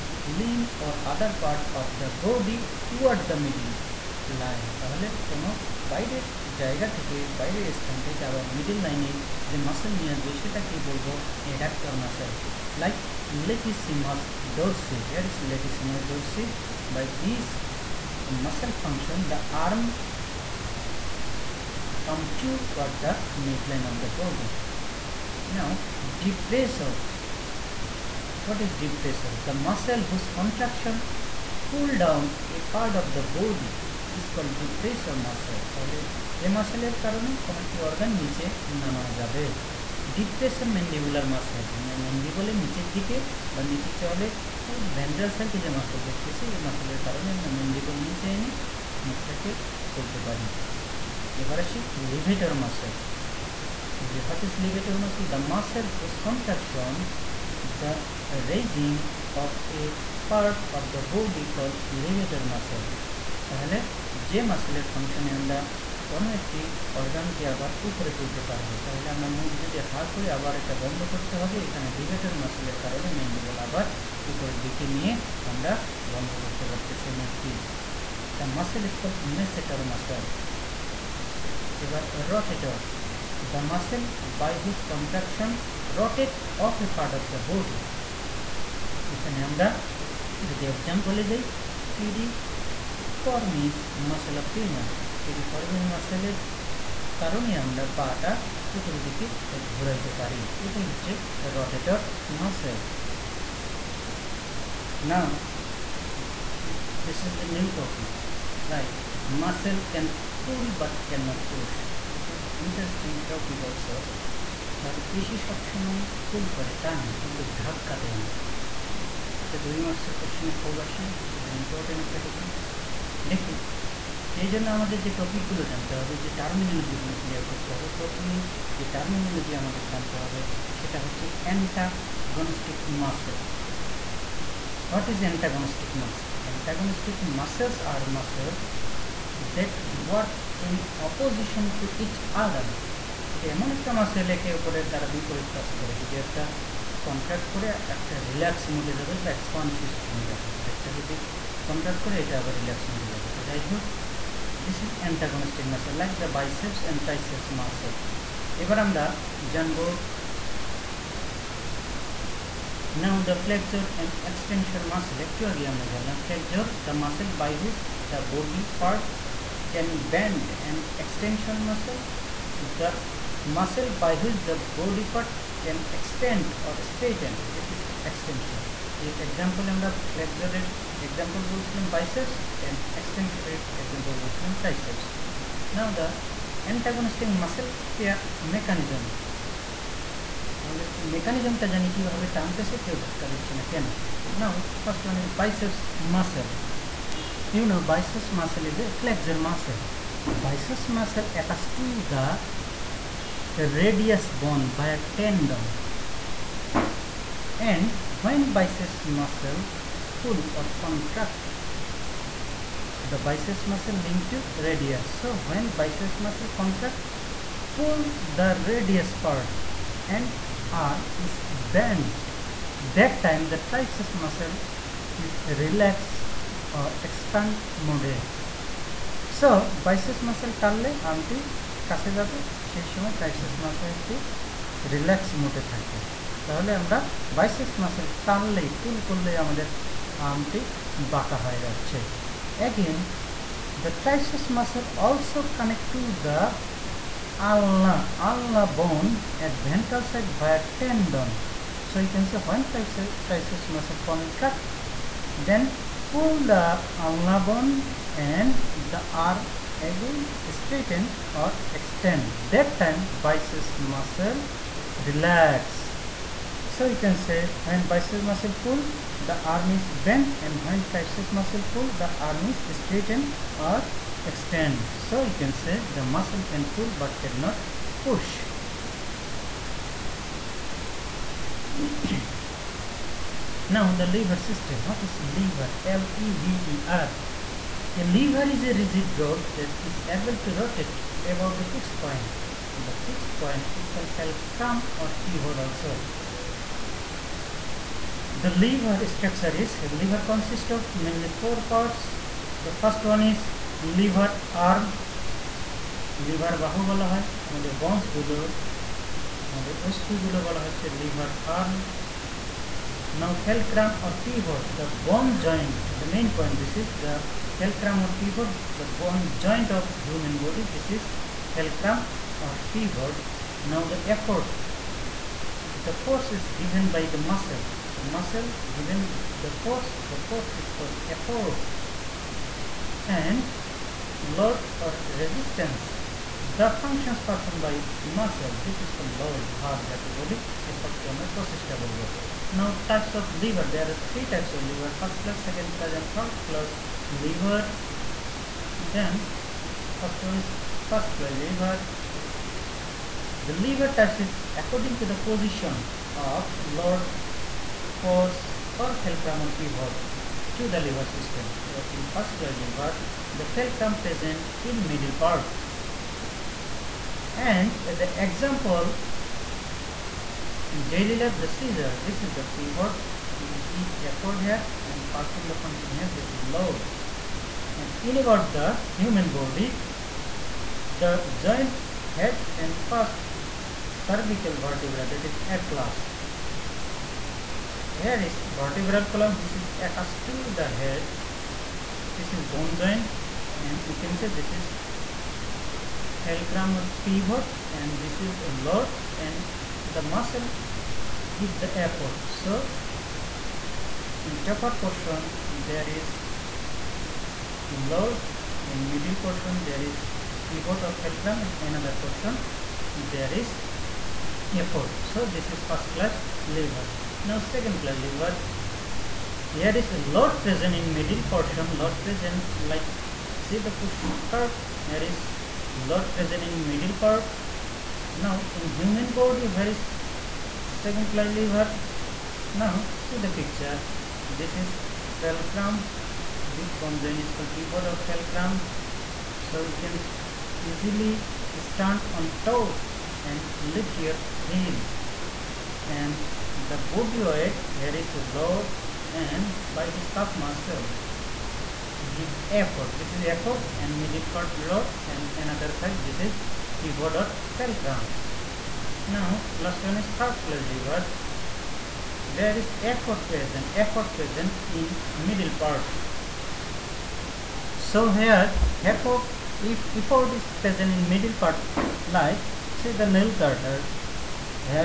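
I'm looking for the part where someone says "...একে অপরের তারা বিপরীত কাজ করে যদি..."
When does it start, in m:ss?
2:24.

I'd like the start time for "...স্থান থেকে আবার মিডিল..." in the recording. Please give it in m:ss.
0:07.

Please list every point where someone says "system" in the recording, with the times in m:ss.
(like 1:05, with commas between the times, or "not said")
4:44, 6:01.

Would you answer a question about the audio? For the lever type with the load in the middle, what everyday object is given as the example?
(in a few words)
Push cart.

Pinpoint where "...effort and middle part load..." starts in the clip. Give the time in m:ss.
7:33.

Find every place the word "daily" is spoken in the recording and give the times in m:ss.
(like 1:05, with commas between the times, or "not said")
6:10.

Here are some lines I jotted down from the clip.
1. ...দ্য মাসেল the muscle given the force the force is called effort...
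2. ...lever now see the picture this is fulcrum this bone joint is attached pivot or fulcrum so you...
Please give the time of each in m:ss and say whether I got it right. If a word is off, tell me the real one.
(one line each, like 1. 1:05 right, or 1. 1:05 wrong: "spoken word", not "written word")
1. 5:27 right
2. 7:11 wrong: "called", not "attached".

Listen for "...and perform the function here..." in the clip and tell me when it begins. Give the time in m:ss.
6:14.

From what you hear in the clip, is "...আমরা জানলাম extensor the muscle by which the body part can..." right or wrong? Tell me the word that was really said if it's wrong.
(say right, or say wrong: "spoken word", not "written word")
wrong: "flexor", not "extensor".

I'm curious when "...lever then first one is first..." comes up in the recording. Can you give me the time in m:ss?
5:47.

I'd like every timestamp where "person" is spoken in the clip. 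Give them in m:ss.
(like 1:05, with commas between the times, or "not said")
not said.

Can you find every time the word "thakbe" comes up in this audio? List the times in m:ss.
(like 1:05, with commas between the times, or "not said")
3:55.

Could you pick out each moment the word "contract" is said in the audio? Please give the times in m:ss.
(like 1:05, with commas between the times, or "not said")
3:30, 3:36.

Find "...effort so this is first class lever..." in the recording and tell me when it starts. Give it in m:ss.
6:54.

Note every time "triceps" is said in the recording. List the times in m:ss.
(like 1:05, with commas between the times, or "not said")
3:43, 3:53, 4:30.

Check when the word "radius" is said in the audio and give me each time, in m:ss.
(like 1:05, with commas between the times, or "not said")
3:34, 3:38.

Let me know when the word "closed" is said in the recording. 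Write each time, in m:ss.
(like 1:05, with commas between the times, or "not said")
7:40.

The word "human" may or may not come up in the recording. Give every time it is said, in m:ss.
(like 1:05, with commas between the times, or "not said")
6:18, 7:08.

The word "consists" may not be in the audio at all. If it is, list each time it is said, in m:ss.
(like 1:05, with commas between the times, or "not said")
5:00.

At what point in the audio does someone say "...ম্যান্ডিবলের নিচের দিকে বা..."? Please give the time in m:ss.
0:42.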